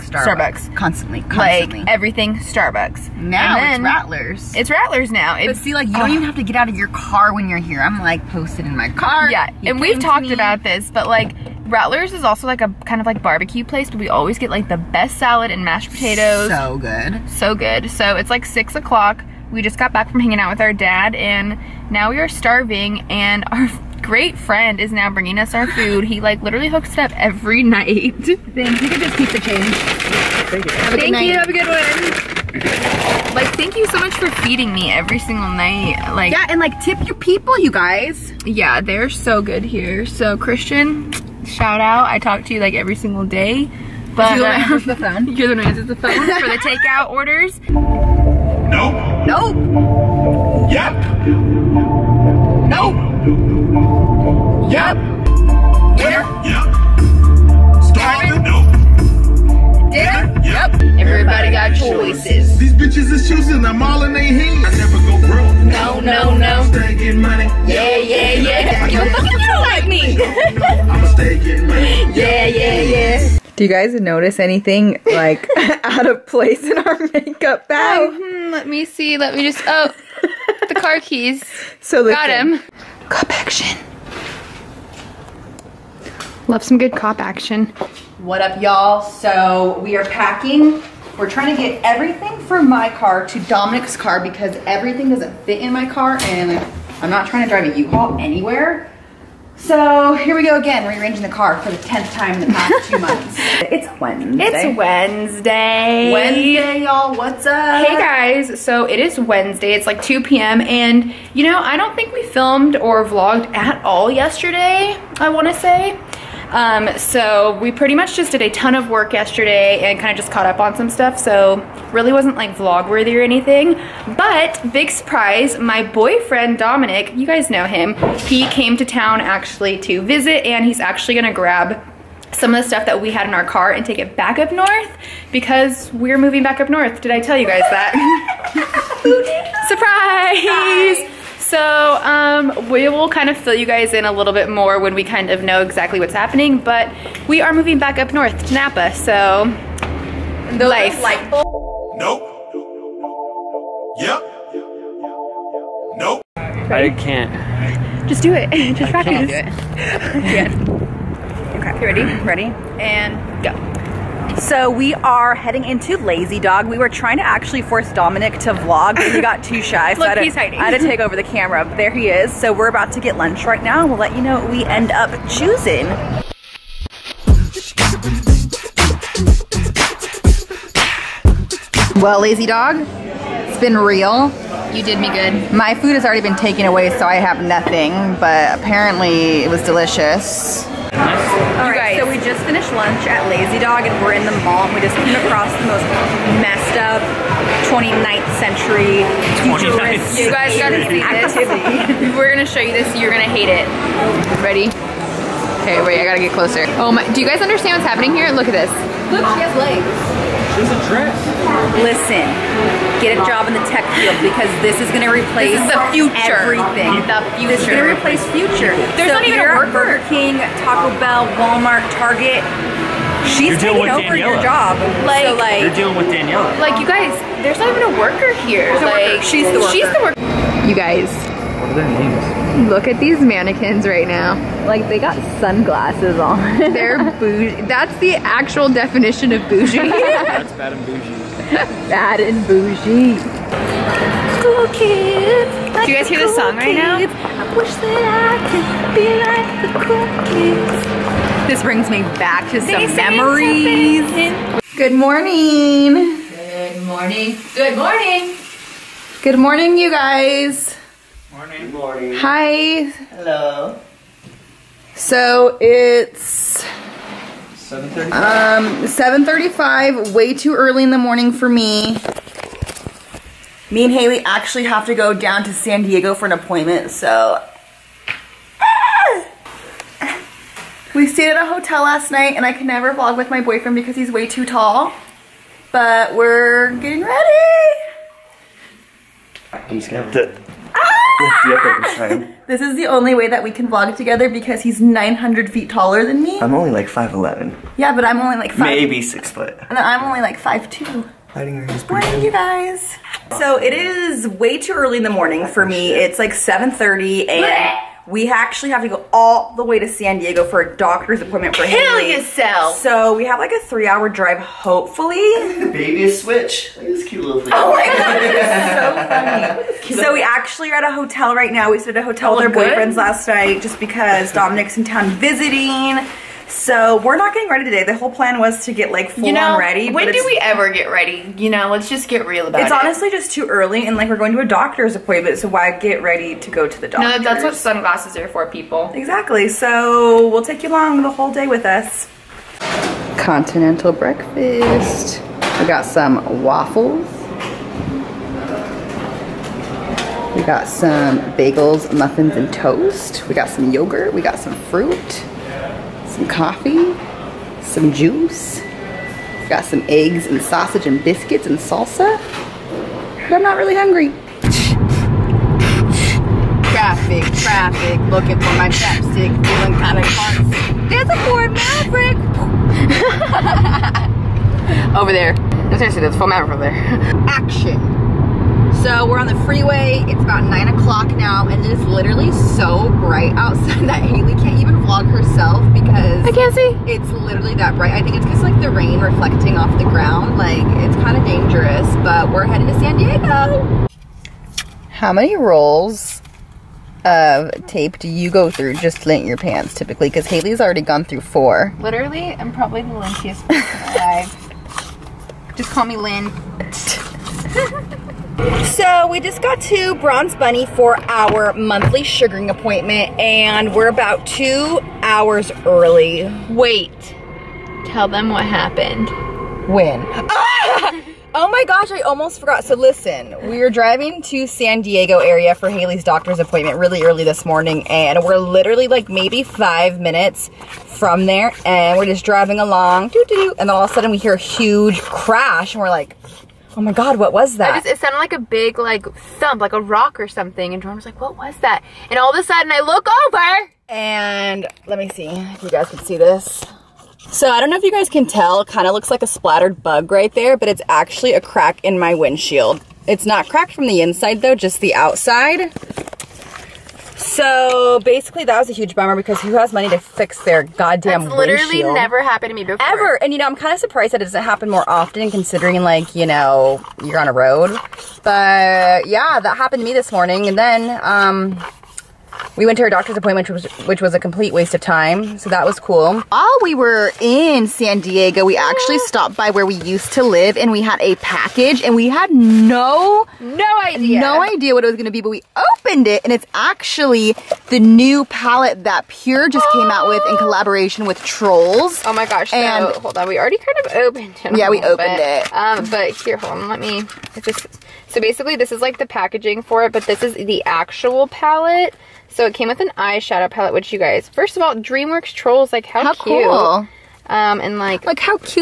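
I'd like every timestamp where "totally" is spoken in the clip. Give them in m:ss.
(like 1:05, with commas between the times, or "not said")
not said.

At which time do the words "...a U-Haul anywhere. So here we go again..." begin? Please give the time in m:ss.
1:37.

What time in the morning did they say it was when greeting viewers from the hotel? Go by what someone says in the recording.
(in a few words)
7:35.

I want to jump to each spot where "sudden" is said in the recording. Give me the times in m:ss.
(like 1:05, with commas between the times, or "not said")
7:13, 7:22.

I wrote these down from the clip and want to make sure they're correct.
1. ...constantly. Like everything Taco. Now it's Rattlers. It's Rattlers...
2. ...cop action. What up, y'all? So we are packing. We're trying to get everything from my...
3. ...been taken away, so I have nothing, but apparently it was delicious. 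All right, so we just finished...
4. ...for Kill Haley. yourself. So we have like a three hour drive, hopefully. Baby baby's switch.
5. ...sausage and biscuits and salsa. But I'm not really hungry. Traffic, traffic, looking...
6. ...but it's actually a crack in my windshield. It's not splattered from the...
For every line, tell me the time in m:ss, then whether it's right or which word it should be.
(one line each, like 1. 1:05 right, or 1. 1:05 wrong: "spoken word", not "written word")
1. 0:01 wrong: "Starbucks", not "Taco"
2. 1:26 right
3. 3:06 right
4. 5:11 right
5. 6:00 right
6. 7:30 wrong: "cracked", not "splattered".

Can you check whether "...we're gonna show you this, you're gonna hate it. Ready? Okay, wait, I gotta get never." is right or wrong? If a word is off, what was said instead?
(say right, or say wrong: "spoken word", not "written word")
wrong: "closer", not "never".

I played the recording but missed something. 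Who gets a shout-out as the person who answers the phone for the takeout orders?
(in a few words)
Christian.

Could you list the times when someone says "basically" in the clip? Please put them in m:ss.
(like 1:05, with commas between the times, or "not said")
7:37, 8:18.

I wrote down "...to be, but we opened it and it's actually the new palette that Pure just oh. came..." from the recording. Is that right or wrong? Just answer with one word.
right.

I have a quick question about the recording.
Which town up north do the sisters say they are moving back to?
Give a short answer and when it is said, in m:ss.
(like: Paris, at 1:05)
Napa, at 2:27.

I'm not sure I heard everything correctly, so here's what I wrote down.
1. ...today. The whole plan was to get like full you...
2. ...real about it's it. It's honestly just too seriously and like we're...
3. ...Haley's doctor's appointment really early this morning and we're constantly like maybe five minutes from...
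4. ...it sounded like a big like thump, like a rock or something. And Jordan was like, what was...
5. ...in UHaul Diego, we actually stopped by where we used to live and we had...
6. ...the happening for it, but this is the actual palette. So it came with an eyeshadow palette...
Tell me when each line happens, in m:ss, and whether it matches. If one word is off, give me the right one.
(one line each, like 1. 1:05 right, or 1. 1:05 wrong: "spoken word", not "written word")
1. 5:27 right
2. 5:32 wrong: "early", not "seriously"
3. 7:05 wrong: "literally", not "constantly"
4. 7:17 right
5. 7:57 wrong: "San", not "UHaul"
6. 8:18 wrong: "packaging", not "happening".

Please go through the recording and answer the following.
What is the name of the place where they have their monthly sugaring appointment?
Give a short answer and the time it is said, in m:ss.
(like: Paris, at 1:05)
Bronzed Bunny, at 6:49.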